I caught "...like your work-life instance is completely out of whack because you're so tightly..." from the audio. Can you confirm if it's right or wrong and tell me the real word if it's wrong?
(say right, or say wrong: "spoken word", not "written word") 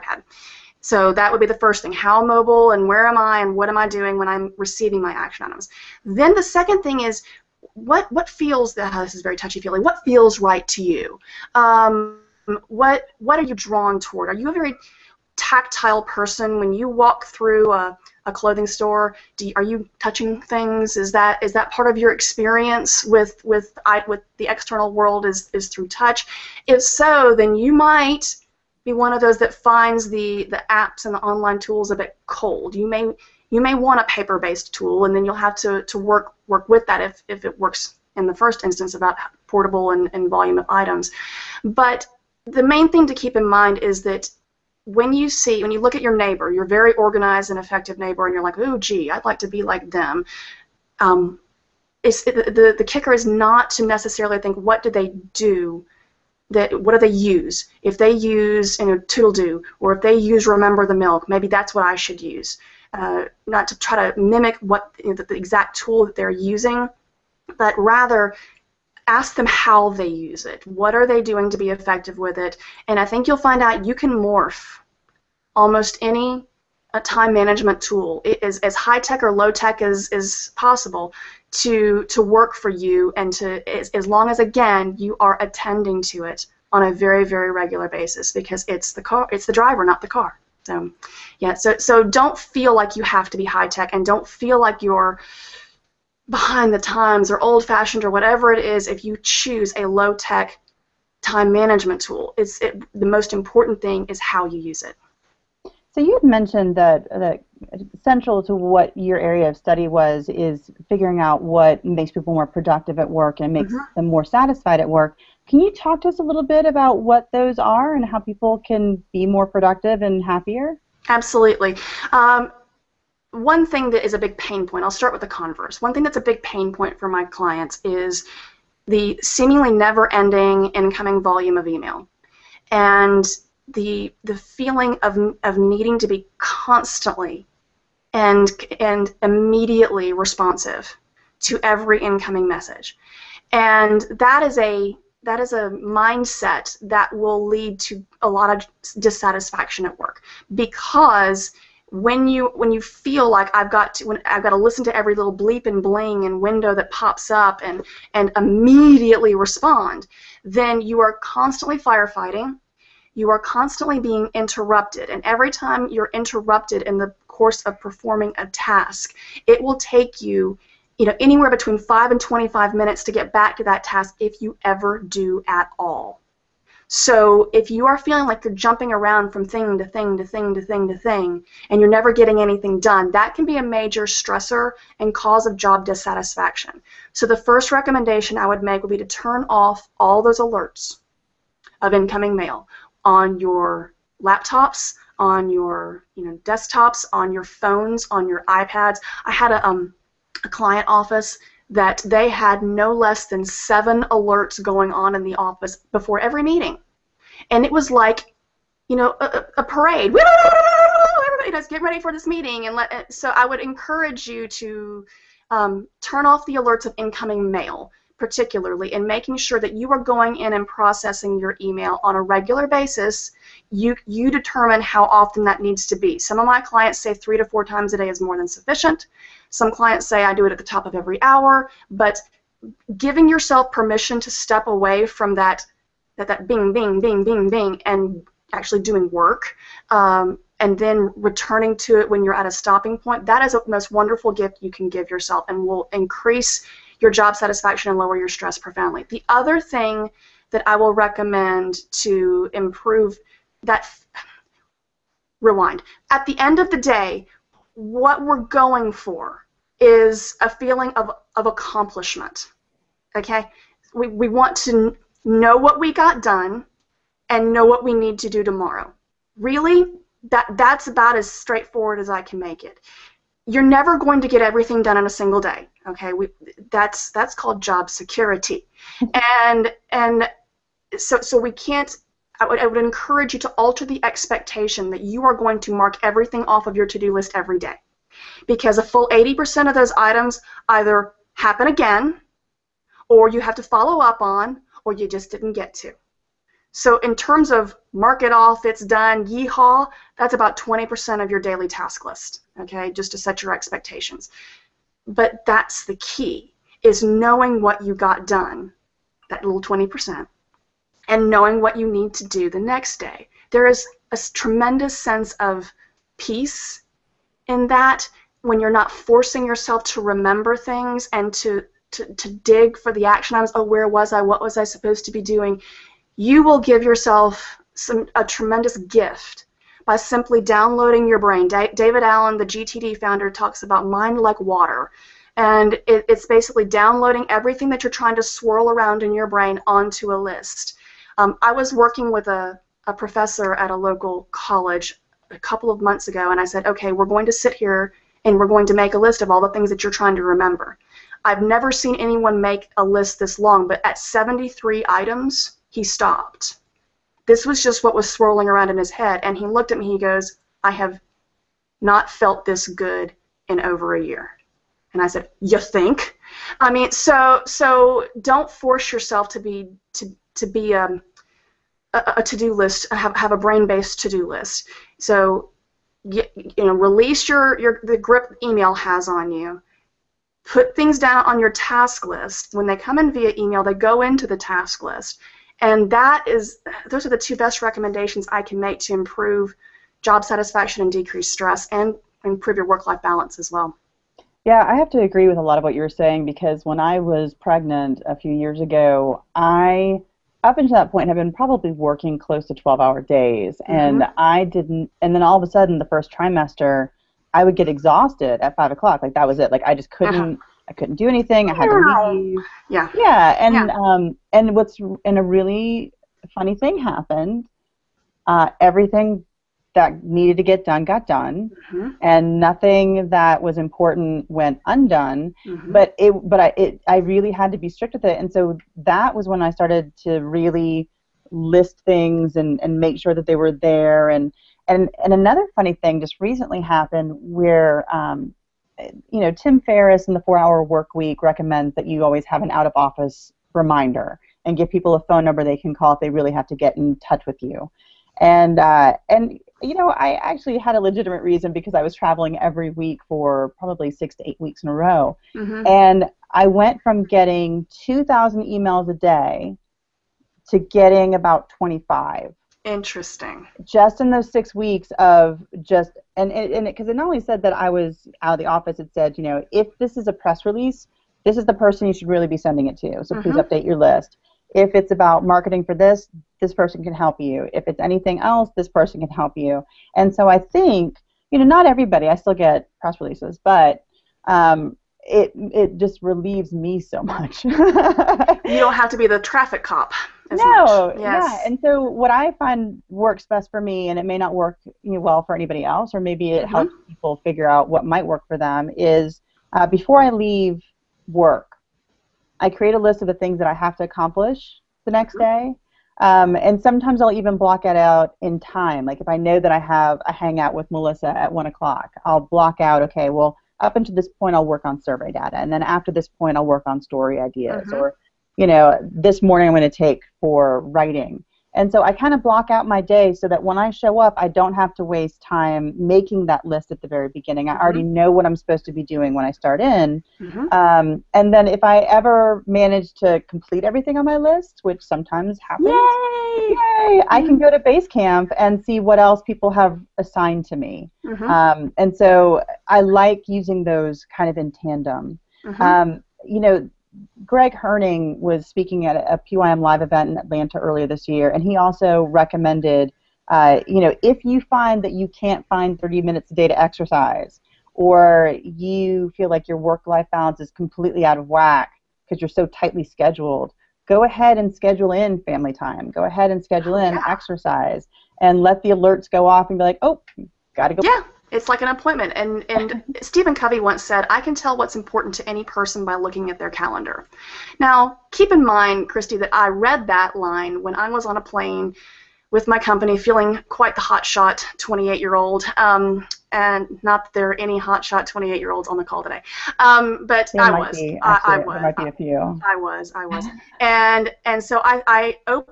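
wrong: "balance", not "instance".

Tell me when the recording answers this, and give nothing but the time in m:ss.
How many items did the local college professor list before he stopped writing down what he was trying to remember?
5:53.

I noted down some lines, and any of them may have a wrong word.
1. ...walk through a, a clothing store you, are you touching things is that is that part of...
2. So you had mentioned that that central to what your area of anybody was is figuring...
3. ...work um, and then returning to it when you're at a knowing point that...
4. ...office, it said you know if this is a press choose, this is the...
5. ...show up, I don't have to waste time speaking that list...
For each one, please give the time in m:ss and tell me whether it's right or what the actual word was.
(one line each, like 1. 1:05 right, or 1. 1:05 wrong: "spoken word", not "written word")
1. 0:16 right
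2. 1:45 wrong: "study", not "anybody"
3. 3:59 wrong: "stopping", not "knowing"
4. 7:48 wrong: "release", not "choose"
5. 8:43 wrong: "making", not "speaking".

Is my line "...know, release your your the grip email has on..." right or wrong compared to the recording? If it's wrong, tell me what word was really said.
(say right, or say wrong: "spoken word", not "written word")
right.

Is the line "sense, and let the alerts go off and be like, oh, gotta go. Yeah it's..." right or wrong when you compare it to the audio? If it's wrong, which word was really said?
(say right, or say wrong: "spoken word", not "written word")
wrong: "exercise", not "sense".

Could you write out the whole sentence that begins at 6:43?
and I didn't and then all of a sudden the first trimester I would get exhausted at five o'clock.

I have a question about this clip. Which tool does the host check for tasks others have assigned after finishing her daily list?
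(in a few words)
Basecamp.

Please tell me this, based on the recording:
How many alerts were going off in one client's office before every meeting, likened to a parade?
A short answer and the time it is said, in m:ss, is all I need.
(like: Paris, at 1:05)
7, at 3:23.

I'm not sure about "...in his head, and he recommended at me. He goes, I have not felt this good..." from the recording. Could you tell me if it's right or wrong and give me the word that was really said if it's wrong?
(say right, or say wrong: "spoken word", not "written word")
wrong: "looked", not "recommended".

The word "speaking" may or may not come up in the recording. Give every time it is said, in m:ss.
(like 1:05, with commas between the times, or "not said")
9:08.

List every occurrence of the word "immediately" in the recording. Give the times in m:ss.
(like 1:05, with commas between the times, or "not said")
2:19, 2:38.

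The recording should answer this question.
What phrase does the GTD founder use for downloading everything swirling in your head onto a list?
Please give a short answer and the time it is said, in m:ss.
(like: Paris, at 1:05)
mind like water, at 5:33.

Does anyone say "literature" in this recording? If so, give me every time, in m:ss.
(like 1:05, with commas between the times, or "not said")
not said.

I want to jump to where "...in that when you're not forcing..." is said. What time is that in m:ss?
5:17.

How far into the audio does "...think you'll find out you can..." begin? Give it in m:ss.
1:13.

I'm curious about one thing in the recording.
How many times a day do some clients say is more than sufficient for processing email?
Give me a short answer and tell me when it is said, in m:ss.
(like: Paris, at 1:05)
3 to 4, at 3:47.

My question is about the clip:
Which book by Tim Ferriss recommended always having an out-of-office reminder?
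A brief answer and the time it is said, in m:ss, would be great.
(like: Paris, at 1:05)
The Four Hour Work Week, at 7:20.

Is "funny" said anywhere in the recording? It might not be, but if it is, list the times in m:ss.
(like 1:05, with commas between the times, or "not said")
6:56, 7:15.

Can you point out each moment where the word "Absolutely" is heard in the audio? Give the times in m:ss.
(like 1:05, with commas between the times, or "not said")
2:01.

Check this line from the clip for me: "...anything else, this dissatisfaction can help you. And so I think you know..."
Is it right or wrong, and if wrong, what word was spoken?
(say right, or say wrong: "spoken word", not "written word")
wrong: "person", not "dissatisfaction".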